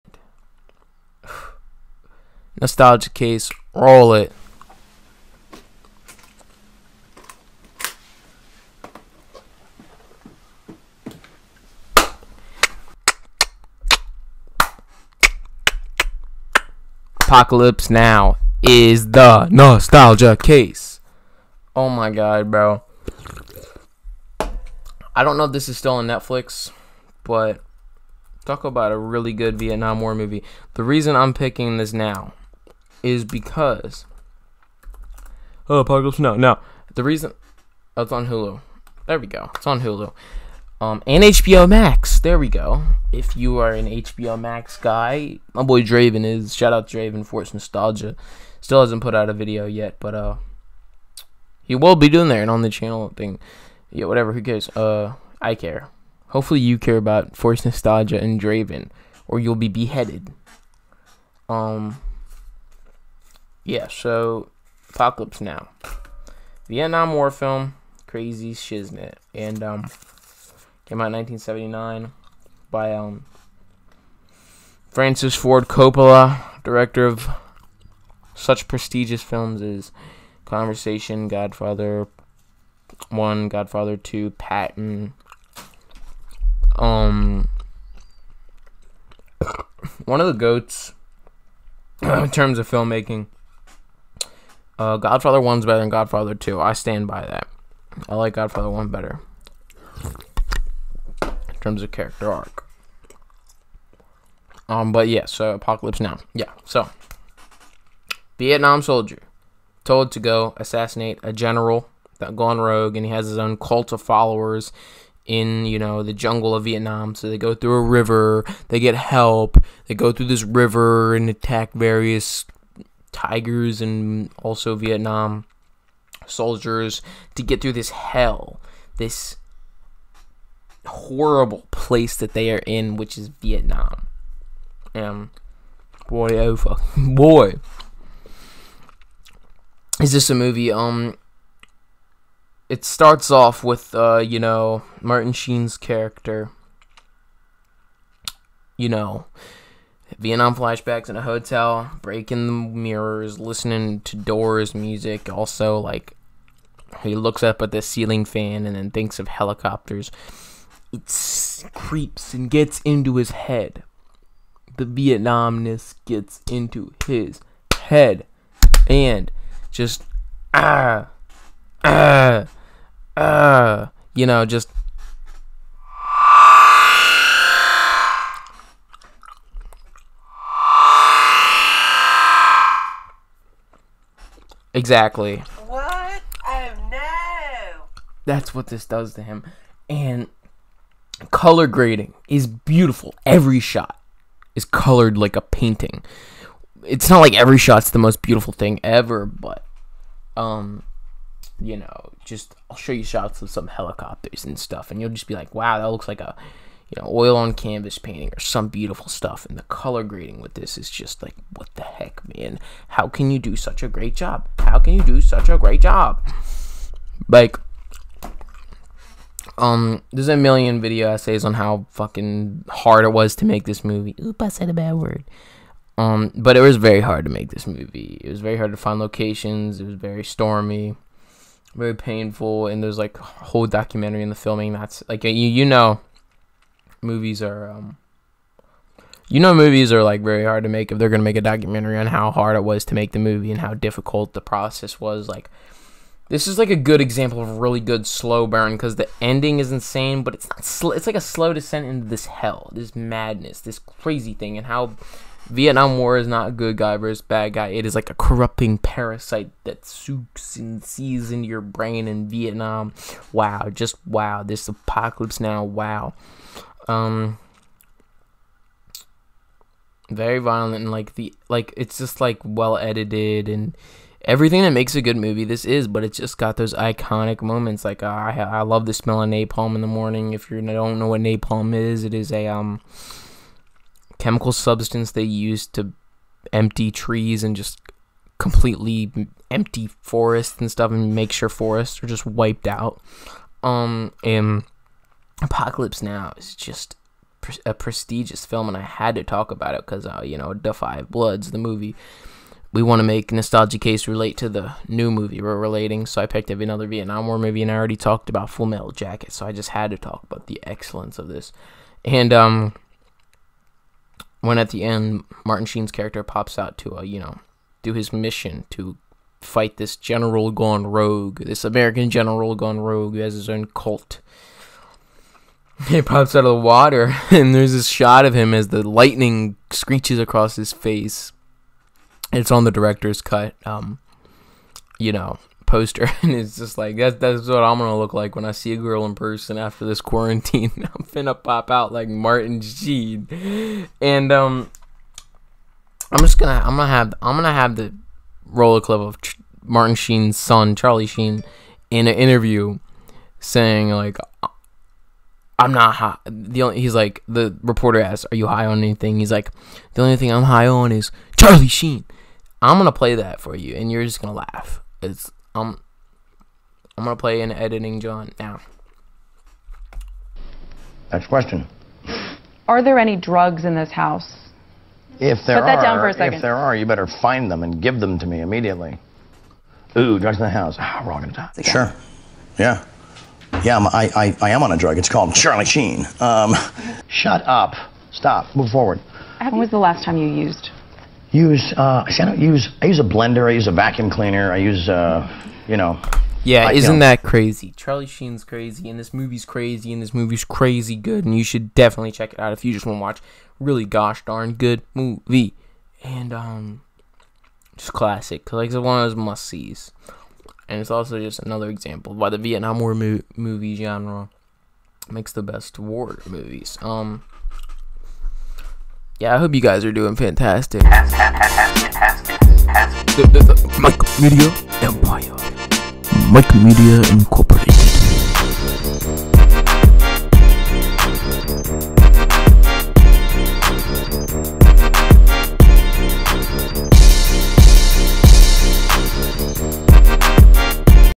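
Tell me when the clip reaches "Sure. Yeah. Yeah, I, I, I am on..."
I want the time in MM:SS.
06:21.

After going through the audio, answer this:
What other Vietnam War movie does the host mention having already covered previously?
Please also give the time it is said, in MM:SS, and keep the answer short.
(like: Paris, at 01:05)
Full Metal Jacket, at 05:08.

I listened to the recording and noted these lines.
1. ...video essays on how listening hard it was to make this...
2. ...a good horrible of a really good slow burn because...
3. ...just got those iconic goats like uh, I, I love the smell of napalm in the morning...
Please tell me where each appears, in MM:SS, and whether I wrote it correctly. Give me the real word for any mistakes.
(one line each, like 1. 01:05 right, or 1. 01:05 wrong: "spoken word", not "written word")
1. 03:40 wrong: "fucking", not "listening"
2. 04:06 wrong: "example", not "horrible"
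3. 04:36 wrong: "moments", not "goats".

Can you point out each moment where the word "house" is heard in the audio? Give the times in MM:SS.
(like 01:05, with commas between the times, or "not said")
06:13, 06:20.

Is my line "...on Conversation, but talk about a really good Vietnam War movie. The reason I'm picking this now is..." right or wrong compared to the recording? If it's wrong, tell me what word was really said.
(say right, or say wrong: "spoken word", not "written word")
wrong: "Netflix", not "Conversation".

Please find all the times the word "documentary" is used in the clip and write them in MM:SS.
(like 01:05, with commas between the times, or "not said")
03:53, 04:01.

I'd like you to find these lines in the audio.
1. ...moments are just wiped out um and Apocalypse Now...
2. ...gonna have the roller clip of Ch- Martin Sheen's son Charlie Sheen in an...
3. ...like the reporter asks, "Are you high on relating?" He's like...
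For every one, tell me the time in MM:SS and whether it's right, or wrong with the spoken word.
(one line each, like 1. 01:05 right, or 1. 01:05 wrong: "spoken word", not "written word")
1. 04:51 wrong: "forests", not "moments"
2. 05:47 right
3. 05:56 wrong: "anything", not "relating".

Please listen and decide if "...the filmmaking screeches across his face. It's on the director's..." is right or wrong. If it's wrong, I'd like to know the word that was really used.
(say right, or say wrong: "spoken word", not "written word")
wrong: "lightning", not "filmmaking".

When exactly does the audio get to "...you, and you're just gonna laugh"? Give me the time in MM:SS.
06:03.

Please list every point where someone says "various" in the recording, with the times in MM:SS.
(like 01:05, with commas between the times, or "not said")
02:01.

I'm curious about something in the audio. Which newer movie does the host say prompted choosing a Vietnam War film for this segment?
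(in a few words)
The Five Bloods.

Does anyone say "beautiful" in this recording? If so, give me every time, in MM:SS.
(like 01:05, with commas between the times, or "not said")
03:12, 03:18, 03:28.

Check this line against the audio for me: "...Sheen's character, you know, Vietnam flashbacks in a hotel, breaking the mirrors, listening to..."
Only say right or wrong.
right.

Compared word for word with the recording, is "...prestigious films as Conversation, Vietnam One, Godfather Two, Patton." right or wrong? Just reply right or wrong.
wrong.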